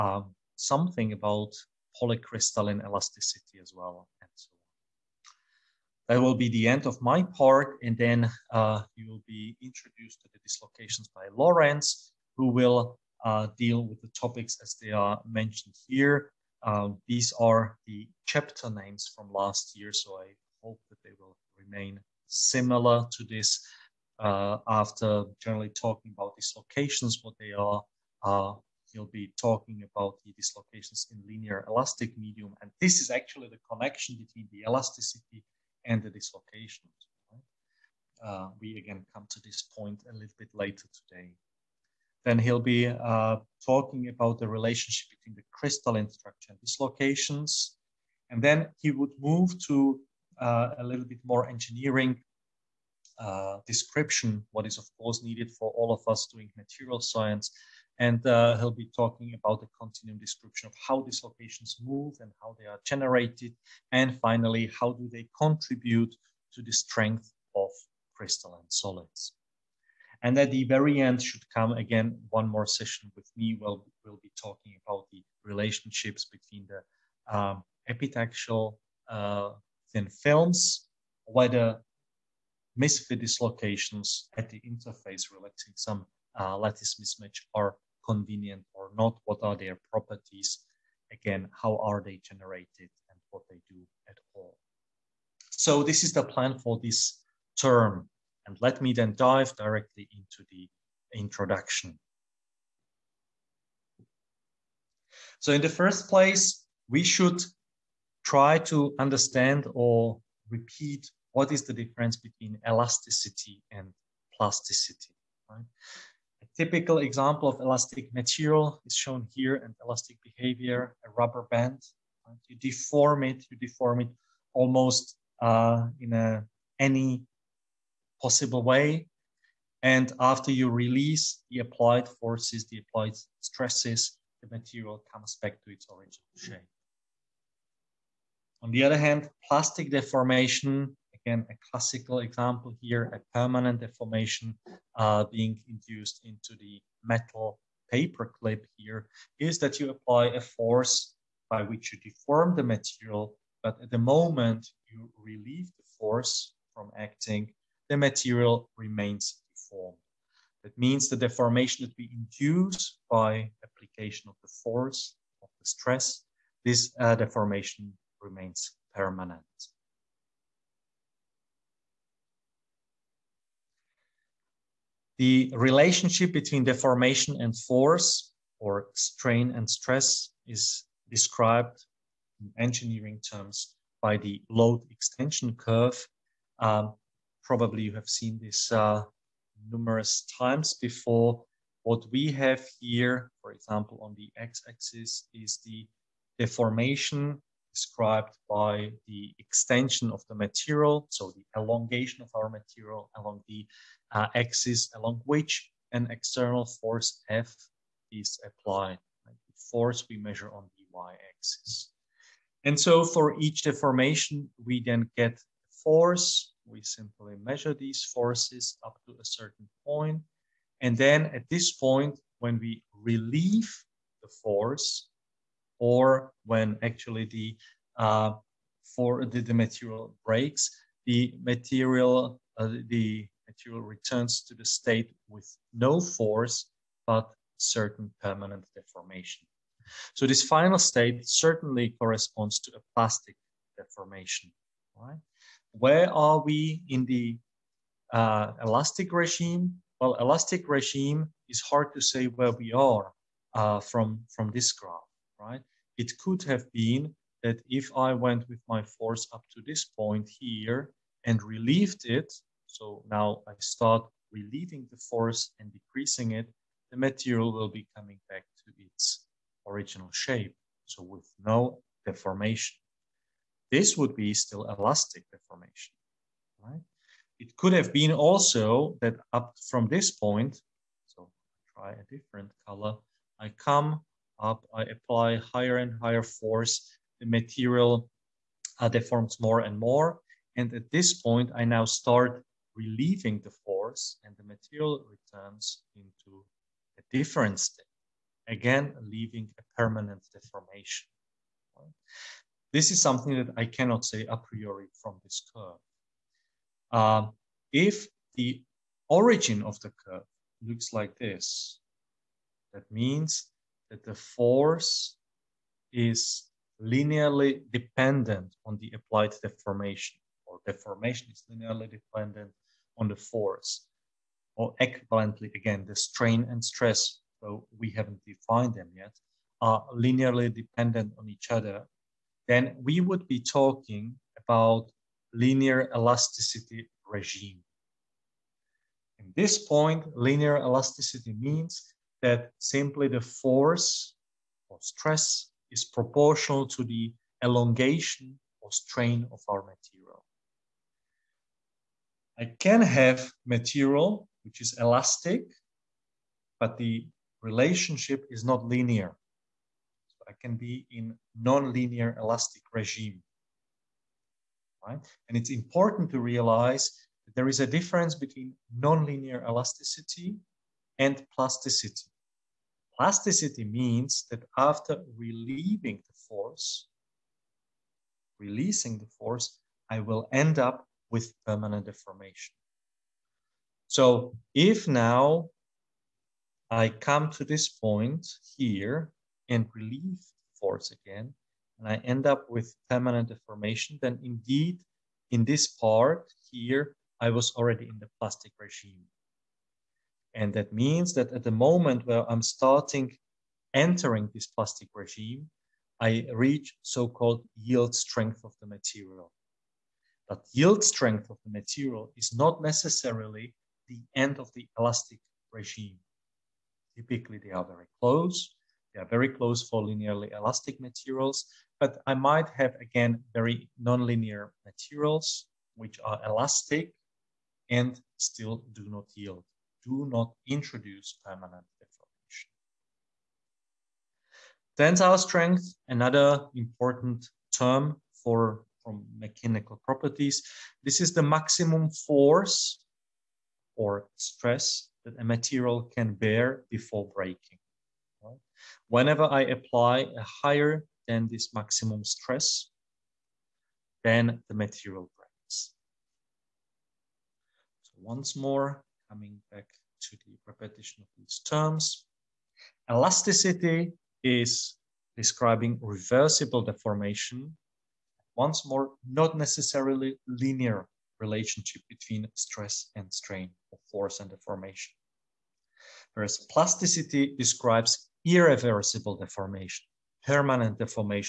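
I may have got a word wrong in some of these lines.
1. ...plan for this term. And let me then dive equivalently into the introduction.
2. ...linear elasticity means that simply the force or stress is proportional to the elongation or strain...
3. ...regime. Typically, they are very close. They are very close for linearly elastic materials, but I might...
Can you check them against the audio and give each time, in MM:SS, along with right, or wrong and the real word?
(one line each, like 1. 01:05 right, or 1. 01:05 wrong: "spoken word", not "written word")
1. 01:36 wrong: "directly", not "equivalently"
2. 05:40 right
3. 06:55 right.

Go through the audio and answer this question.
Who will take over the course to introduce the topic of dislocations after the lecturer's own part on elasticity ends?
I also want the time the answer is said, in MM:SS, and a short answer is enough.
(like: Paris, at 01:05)
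Lawrence, at 00:11.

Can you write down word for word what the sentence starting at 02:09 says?
And after you release the applied forces, the applied stresses, the material comes back to its original shape.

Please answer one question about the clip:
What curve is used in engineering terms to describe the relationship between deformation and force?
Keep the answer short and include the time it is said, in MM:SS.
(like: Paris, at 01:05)
load extension curve, at 03:04.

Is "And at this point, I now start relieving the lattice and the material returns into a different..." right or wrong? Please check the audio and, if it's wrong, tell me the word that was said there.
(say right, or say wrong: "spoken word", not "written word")
wrong: "force", not "lattice".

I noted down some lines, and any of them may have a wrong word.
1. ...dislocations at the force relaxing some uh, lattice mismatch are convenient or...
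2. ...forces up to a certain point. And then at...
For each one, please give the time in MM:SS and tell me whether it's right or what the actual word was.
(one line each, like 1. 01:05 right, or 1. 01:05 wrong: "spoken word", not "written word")
1. 01:23 wrong: "interface", not "force"
2. 03:38 right.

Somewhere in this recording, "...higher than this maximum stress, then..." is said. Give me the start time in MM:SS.
07:30.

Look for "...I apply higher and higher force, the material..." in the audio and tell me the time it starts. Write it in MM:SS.
04:44.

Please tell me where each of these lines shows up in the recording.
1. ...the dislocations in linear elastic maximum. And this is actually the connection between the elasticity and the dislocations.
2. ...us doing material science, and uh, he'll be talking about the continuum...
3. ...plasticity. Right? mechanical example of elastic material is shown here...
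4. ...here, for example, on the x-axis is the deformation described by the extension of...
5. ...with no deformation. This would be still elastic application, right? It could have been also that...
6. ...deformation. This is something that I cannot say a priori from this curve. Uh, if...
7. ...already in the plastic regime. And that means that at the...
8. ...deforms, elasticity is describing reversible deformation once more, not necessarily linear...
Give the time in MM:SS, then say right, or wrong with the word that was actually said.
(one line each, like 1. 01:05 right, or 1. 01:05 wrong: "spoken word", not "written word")
1. 00:30 wrong: "medium", not "maximum"
2. 00:56 right
3. 01:54 wrong: "typical", not "mechanical"
4. 03:12 right
5. 04:31 wrong: "deformation", not "application"
6. 05:00 right
7. 06:37 right
8. 07:41 wrong: "terms", not "deforms".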